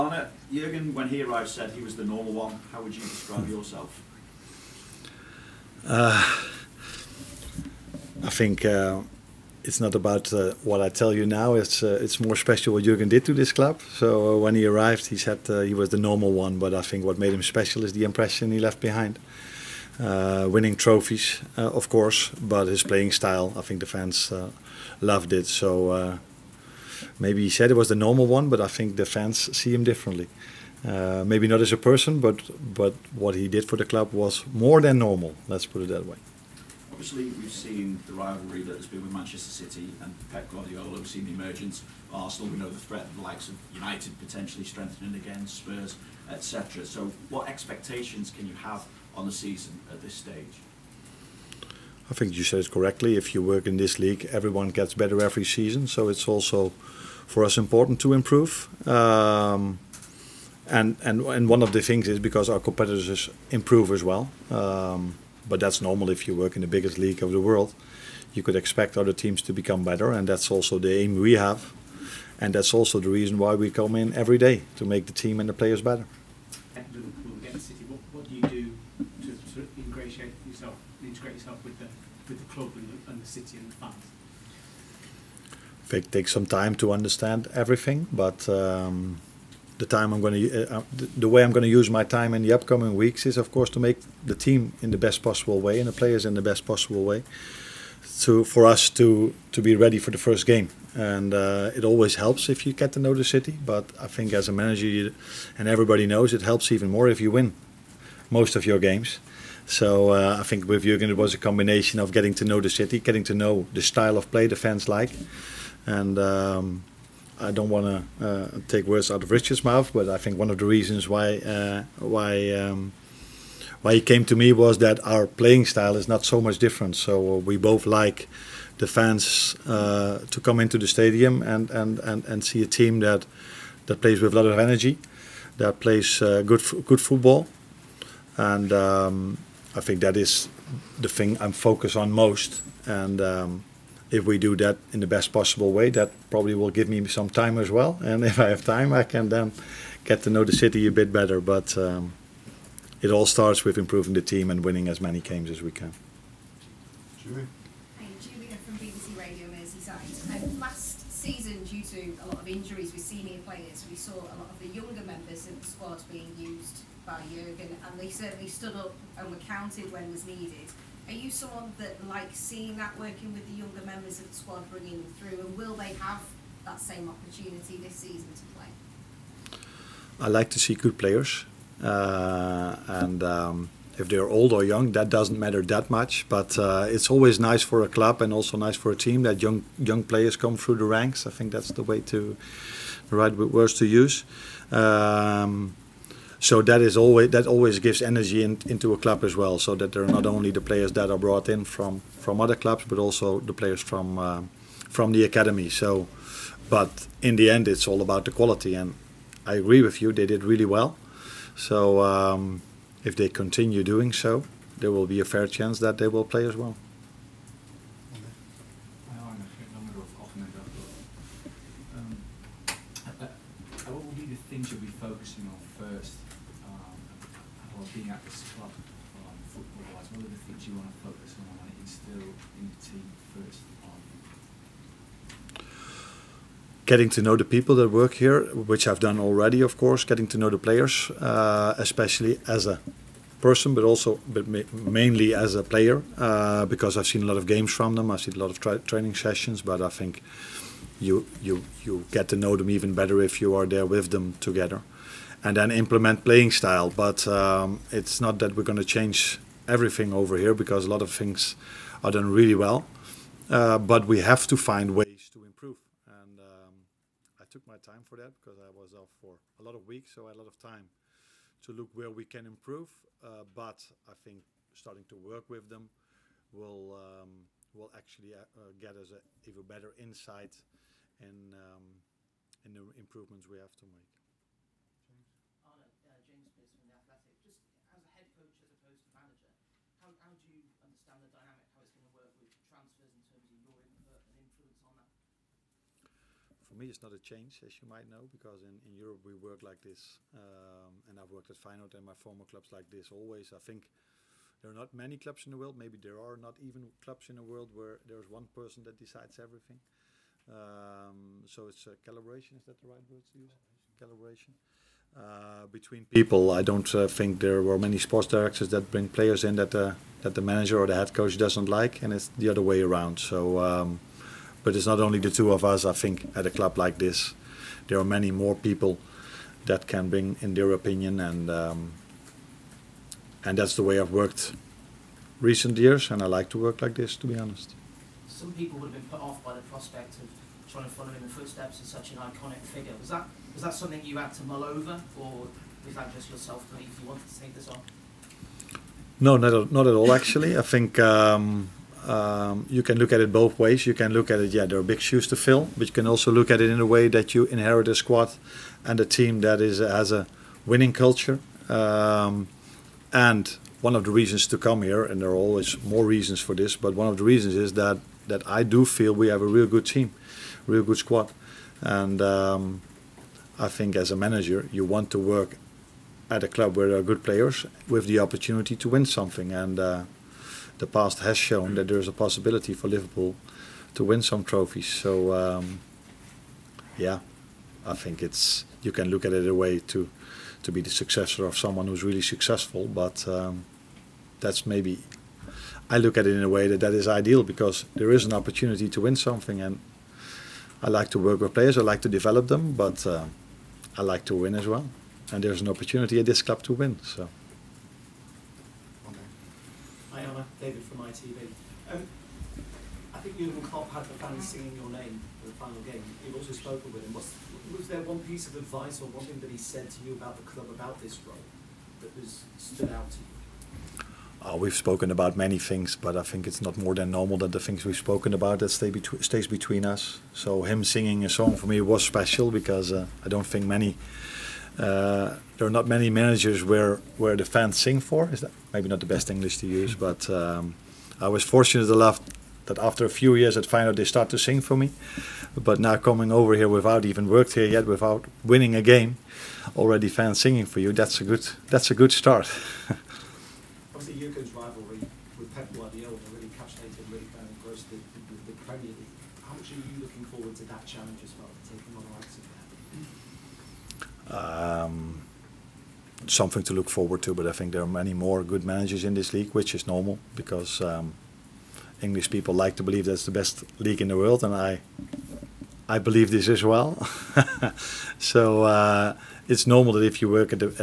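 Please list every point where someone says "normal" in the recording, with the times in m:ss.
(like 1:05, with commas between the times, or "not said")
0:02, 0:15, 0:27, 0:34, 1:05, 7:07, 7:49, 7:59.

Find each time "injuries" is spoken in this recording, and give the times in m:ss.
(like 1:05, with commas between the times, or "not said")
2:42.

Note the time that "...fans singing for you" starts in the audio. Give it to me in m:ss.
7:30.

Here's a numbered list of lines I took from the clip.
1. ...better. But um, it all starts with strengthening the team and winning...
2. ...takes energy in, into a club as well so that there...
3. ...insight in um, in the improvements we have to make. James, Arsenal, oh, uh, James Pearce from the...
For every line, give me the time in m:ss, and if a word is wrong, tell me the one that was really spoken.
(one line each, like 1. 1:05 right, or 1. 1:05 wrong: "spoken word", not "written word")
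1. 2:31 wrong: "improving", not "strengthening"
2. 3:17 wrong: "gives", not "takes"
3. 4:39 wrong: "Arno", not "Arsenal".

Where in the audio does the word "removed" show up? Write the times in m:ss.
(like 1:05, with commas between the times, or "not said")
not said.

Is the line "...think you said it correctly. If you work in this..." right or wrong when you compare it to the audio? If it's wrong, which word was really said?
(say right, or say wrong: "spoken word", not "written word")
right.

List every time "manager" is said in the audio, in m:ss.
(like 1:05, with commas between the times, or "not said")
1:44, 4:49, 5:20, 6:14, 7:16, 7:48.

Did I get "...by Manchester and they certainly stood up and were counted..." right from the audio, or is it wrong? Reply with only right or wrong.
wrong.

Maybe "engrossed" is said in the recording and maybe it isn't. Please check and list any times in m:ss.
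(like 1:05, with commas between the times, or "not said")
7:37.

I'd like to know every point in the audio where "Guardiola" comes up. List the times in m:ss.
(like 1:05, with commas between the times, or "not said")
0:40, 7:35.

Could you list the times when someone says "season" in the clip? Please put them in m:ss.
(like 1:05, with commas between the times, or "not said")
0:49, 0:55, 2:41, 2:57.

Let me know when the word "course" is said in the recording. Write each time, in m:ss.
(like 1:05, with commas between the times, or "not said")
0:21, 1:33, 3:59.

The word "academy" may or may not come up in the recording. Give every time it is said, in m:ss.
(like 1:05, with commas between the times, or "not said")
3:25.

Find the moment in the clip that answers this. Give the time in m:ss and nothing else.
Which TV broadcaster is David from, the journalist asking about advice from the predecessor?
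6:50.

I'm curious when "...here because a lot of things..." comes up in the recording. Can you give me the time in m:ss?
4:20.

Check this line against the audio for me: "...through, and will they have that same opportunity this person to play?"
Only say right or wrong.
wrong.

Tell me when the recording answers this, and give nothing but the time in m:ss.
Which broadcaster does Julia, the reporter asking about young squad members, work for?
2:38.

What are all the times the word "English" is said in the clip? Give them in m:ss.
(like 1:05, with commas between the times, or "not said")
7:19, 7:52.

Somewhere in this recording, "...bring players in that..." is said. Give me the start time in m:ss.
5:18.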